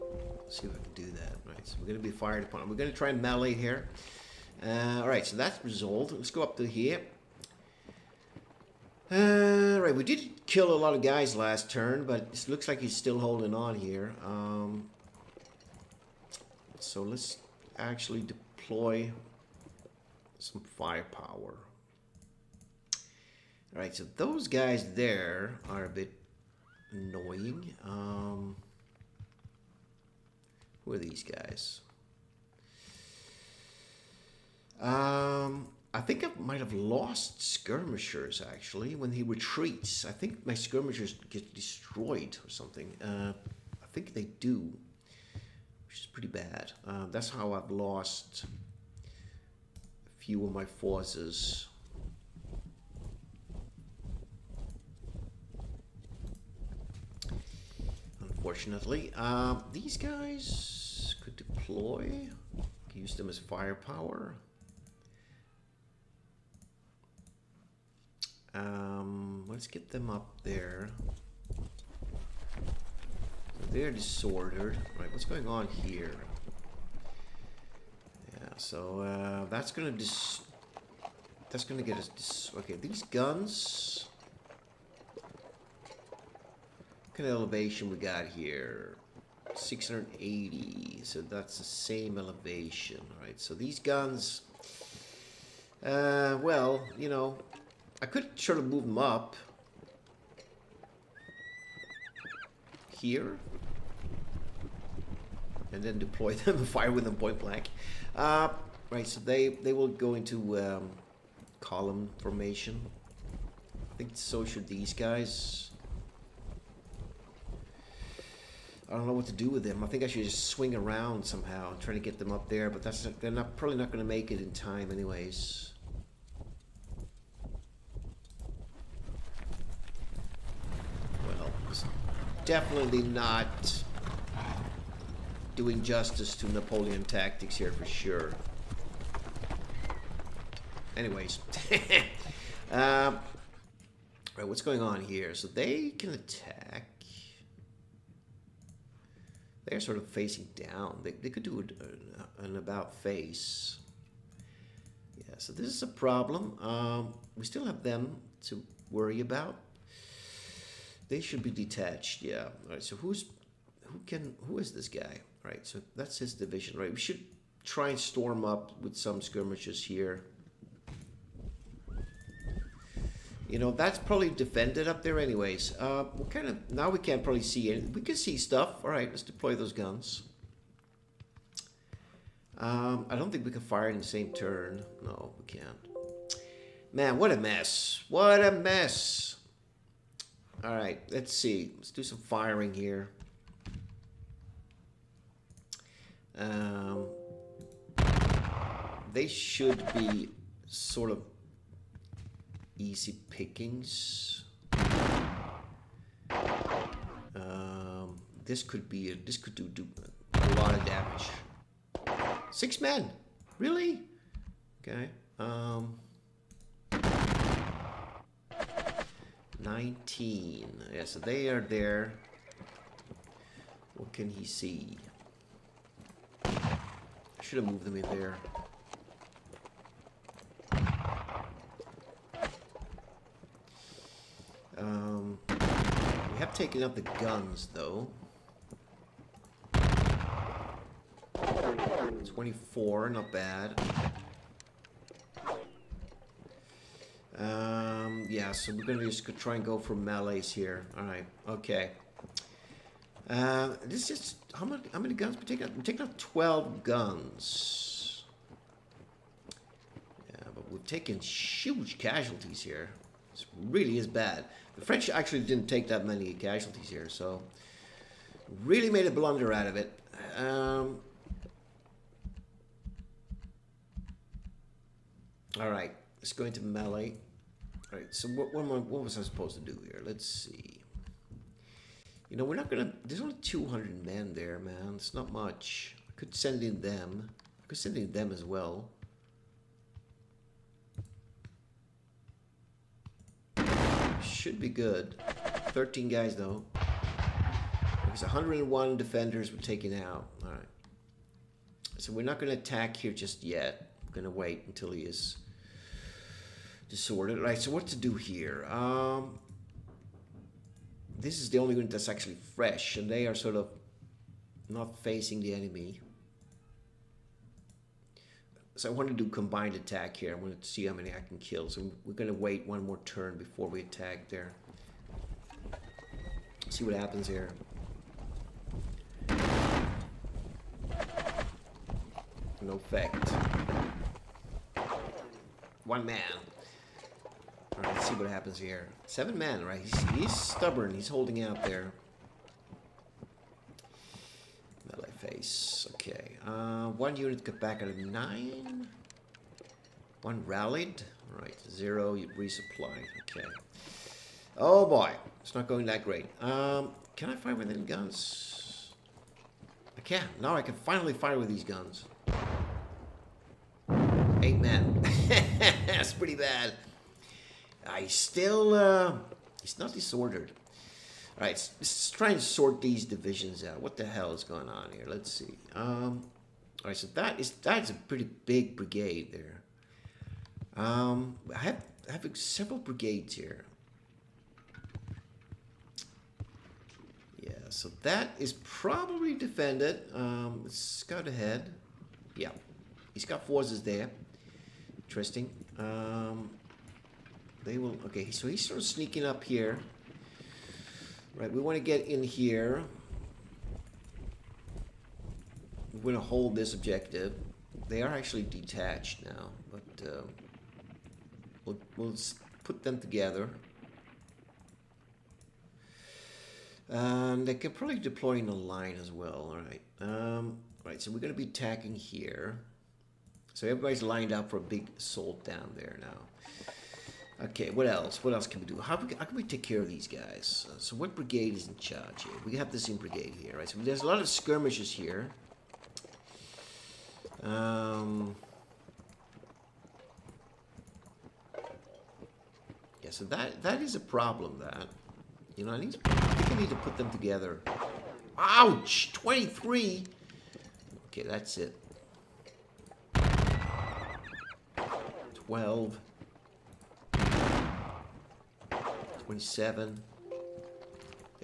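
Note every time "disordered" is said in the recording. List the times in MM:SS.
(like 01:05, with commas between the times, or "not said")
01:13, 05:06, 06:09.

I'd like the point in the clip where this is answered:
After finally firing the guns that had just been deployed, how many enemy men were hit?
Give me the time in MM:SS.
06:04.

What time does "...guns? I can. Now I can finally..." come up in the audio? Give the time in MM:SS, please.
05:57.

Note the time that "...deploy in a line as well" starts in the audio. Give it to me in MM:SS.
06:57.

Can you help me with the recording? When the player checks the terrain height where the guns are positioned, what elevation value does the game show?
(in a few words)
680.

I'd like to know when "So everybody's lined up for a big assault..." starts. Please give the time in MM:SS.
07:03.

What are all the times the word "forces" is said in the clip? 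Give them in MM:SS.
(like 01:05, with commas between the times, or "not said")
00:50, 06:33.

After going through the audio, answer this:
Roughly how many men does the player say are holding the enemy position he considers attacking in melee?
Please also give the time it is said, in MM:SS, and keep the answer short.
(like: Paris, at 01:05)
200, at 04:43.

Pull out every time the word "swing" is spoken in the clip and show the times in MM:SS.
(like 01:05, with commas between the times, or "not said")
02:00.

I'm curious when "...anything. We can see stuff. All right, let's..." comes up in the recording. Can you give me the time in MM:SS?
02:57.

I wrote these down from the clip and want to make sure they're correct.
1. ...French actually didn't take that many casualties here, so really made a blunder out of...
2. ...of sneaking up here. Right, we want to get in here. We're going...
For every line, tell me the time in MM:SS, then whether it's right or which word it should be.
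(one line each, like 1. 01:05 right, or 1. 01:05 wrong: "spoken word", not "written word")
1. 04:24 right
2. 06:38 right.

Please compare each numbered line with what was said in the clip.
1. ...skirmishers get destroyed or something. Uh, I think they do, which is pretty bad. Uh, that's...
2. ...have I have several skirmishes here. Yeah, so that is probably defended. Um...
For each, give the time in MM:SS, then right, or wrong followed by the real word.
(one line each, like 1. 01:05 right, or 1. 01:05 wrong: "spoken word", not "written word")
1. 00:40 right
2. 06:21 wrong: "brigades", not "skirmishes".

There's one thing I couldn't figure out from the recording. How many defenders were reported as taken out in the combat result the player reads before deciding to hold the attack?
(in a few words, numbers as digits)
101.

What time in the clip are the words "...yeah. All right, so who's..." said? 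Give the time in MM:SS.
02:42.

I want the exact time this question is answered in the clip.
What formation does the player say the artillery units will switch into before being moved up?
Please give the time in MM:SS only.
01:51.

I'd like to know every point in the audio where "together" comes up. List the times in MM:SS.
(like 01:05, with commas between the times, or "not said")
06:52, 07:27.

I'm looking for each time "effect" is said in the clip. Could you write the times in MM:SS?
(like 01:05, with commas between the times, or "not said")
05:32.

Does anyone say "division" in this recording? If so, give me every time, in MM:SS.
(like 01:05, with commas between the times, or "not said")
02:46, 06:13.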